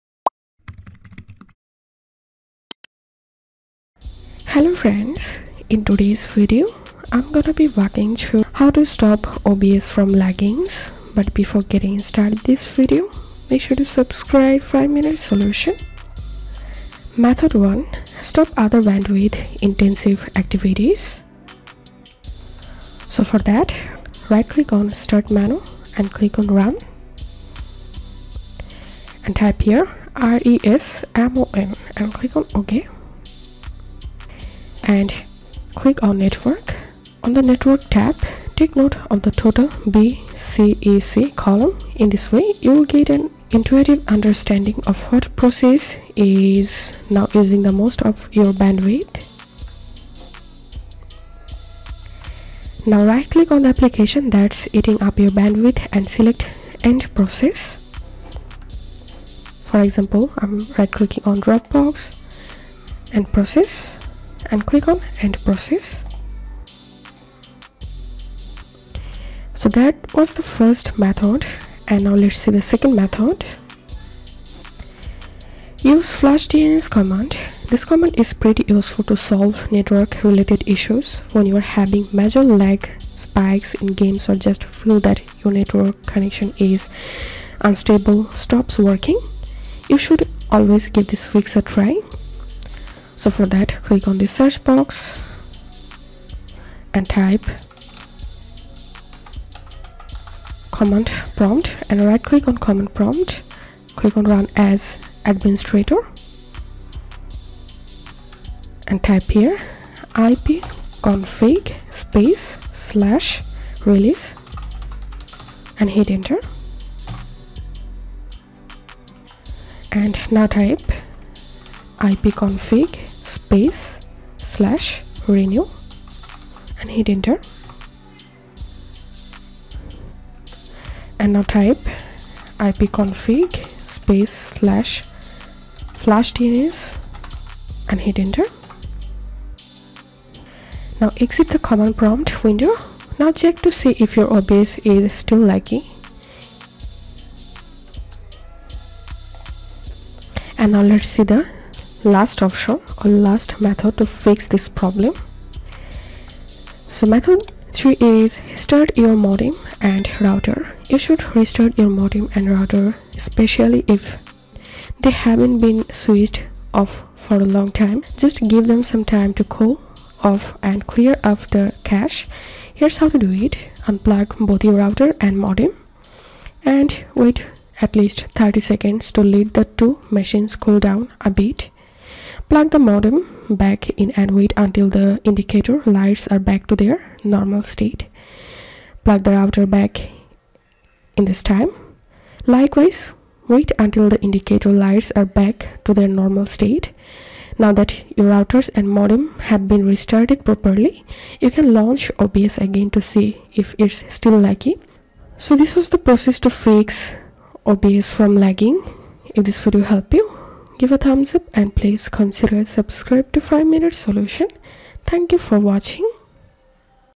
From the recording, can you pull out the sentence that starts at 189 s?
Plug the router back in this time.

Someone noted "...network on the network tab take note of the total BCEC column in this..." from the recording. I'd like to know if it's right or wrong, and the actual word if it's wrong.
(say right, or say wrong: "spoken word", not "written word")
right.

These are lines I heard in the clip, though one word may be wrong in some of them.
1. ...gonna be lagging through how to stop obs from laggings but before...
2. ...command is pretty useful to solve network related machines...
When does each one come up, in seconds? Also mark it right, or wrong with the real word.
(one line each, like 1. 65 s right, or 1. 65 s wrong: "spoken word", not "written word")
1. 7 s wrong: "walking", not "lagging"
2. 77 s wrong: "issues", not "machines".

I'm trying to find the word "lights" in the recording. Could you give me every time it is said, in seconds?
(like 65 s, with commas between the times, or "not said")
185 s, 194 s.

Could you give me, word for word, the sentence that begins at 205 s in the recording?
So this was the process to fix OBS from lagging.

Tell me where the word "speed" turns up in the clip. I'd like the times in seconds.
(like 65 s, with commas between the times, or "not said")
not said.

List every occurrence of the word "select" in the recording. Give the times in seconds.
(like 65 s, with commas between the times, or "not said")
56 s.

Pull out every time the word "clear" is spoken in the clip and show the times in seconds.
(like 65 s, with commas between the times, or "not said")
170 s.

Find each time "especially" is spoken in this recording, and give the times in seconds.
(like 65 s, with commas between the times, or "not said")
163 s.